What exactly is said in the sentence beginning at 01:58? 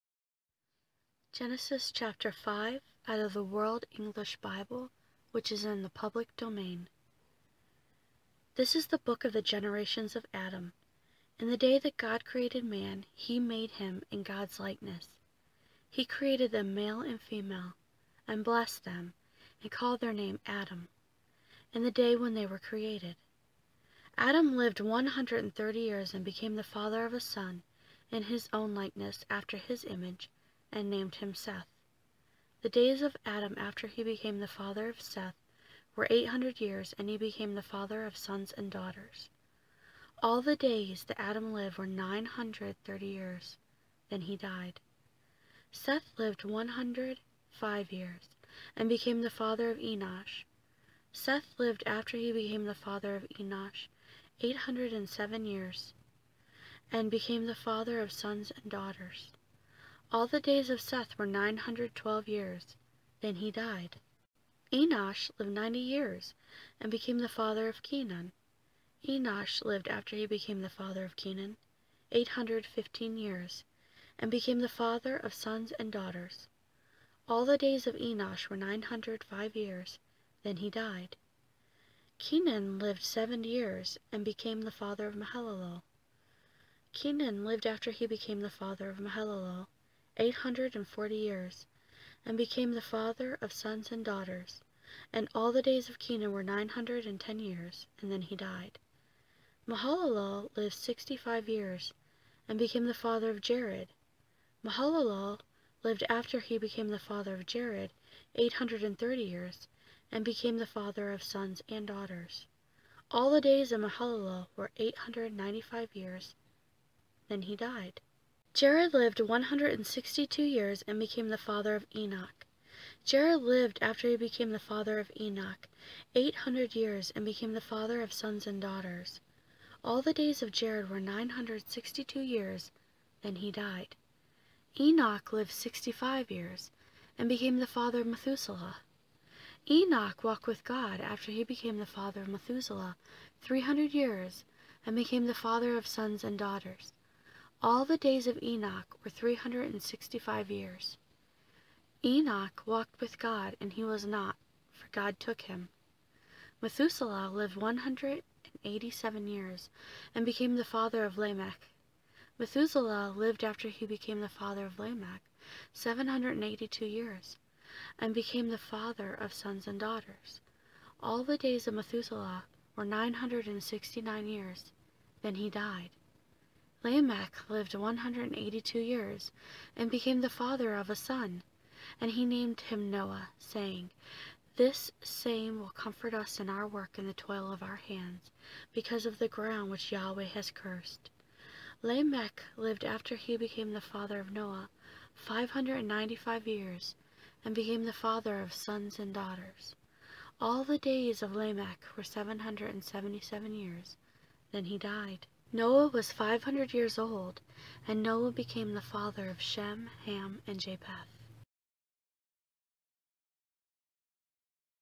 Jared lived 162 years and became the father of Enoch.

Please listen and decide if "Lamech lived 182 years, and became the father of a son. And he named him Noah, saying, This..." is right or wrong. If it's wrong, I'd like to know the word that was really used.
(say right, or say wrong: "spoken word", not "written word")
right.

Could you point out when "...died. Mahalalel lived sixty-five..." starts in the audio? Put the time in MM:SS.
01:38.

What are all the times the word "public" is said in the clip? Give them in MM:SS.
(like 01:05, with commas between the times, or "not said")
00:05.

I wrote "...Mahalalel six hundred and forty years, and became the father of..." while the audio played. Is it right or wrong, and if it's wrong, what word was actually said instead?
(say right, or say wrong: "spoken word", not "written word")
wrong: "eight", not "six".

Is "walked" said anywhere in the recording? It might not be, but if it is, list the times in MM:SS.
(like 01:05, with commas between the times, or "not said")
02:20, 02:32.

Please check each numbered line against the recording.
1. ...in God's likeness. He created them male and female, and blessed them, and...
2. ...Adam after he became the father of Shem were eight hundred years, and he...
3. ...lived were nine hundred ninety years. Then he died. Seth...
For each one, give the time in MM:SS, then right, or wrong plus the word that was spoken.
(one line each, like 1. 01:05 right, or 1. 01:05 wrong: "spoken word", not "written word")
1. 00:14 right
2. 00:33 wrong: "Seth", not "Shem"
3. 00:41 wrong: "thirty", not "ninety".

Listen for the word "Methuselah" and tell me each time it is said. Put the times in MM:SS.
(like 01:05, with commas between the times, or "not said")
02:18, 02:22, 02:36, 02:42, 02:51.